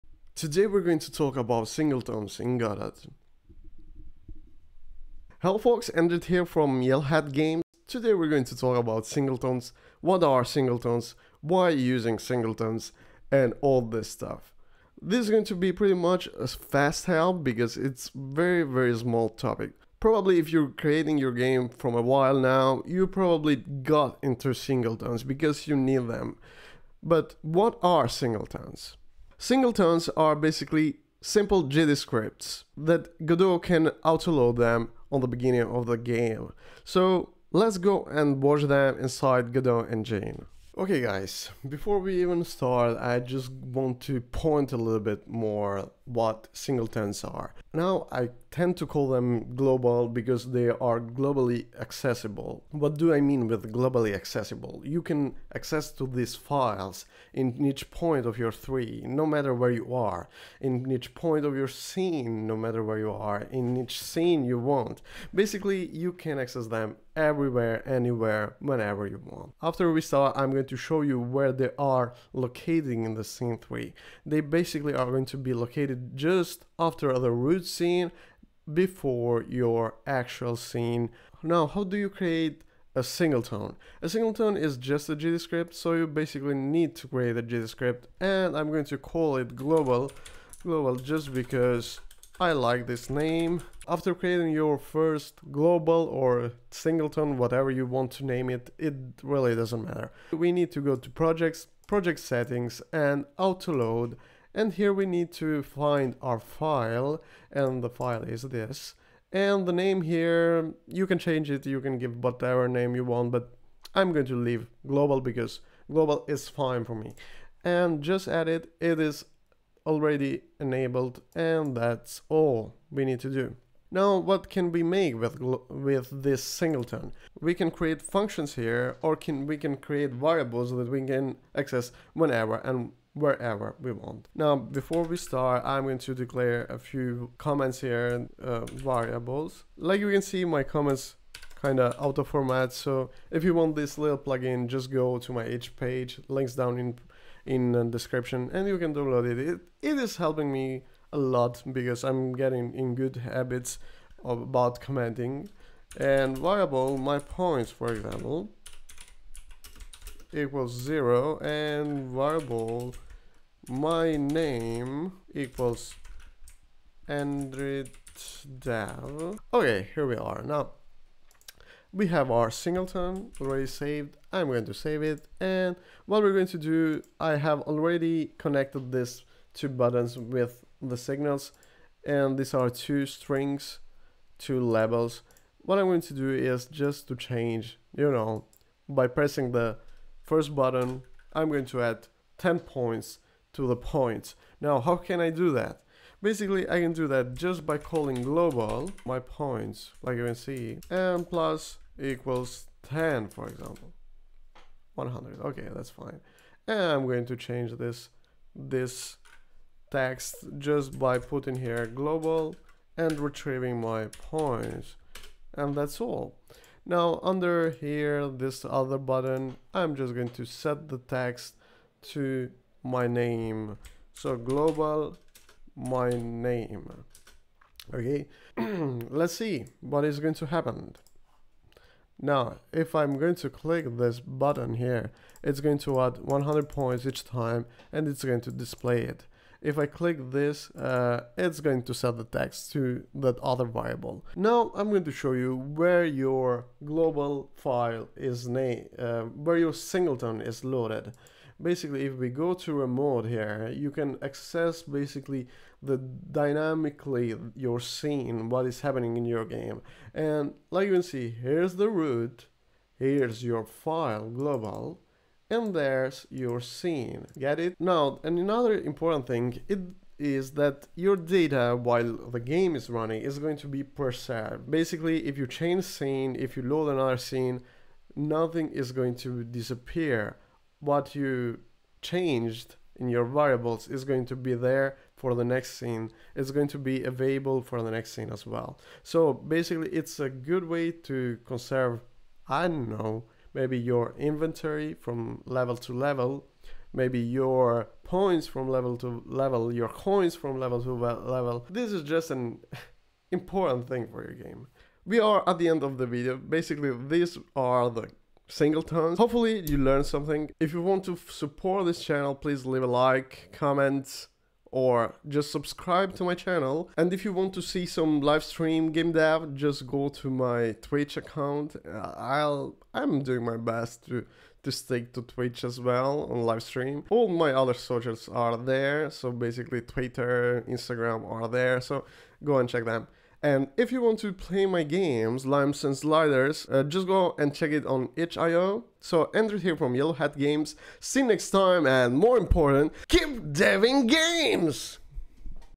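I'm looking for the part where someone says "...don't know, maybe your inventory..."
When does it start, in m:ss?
4:52.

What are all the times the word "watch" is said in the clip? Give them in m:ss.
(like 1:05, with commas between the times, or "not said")
0:38.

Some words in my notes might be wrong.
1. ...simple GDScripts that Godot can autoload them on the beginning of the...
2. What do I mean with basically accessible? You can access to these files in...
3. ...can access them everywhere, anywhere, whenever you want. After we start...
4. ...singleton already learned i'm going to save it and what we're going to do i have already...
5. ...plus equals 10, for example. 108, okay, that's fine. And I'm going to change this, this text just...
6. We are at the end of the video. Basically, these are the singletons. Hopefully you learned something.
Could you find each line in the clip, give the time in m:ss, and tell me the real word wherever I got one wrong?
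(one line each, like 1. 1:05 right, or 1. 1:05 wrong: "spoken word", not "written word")
1. 0:31 right
2. 0:52 wrong: "globally", not "basically"
3. 1:06 right
4. 2:52 wrong: "saved", not "learned"
5. 3:21 wrong: "100", not "108"
6. 5:05 right.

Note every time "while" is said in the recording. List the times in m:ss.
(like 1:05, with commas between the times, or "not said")
0:22, 4:31.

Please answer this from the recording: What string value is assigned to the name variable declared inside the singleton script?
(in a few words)
endrit dev.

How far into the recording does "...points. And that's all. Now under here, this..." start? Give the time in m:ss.
3:34.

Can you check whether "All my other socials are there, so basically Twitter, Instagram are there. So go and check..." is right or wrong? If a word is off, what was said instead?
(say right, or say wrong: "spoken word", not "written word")
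right.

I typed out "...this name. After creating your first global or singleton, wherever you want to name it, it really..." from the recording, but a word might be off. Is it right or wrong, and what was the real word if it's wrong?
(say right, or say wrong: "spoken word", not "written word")
wrong: "whatever", not "wherever".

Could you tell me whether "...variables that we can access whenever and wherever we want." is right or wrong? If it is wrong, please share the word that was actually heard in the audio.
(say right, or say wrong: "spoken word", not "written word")
right.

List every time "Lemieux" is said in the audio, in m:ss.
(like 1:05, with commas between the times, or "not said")
not said.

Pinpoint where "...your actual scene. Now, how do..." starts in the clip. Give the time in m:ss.
1:19.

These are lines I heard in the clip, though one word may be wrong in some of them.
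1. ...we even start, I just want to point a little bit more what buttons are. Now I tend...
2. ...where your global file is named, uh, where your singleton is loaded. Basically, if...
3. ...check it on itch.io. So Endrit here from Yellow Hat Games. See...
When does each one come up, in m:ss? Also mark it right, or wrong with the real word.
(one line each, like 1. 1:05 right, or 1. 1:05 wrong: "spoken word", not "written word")
1. 0:41 wrong: "singletons", not "buttons"
2. 4:05 right
3. 5:37 right.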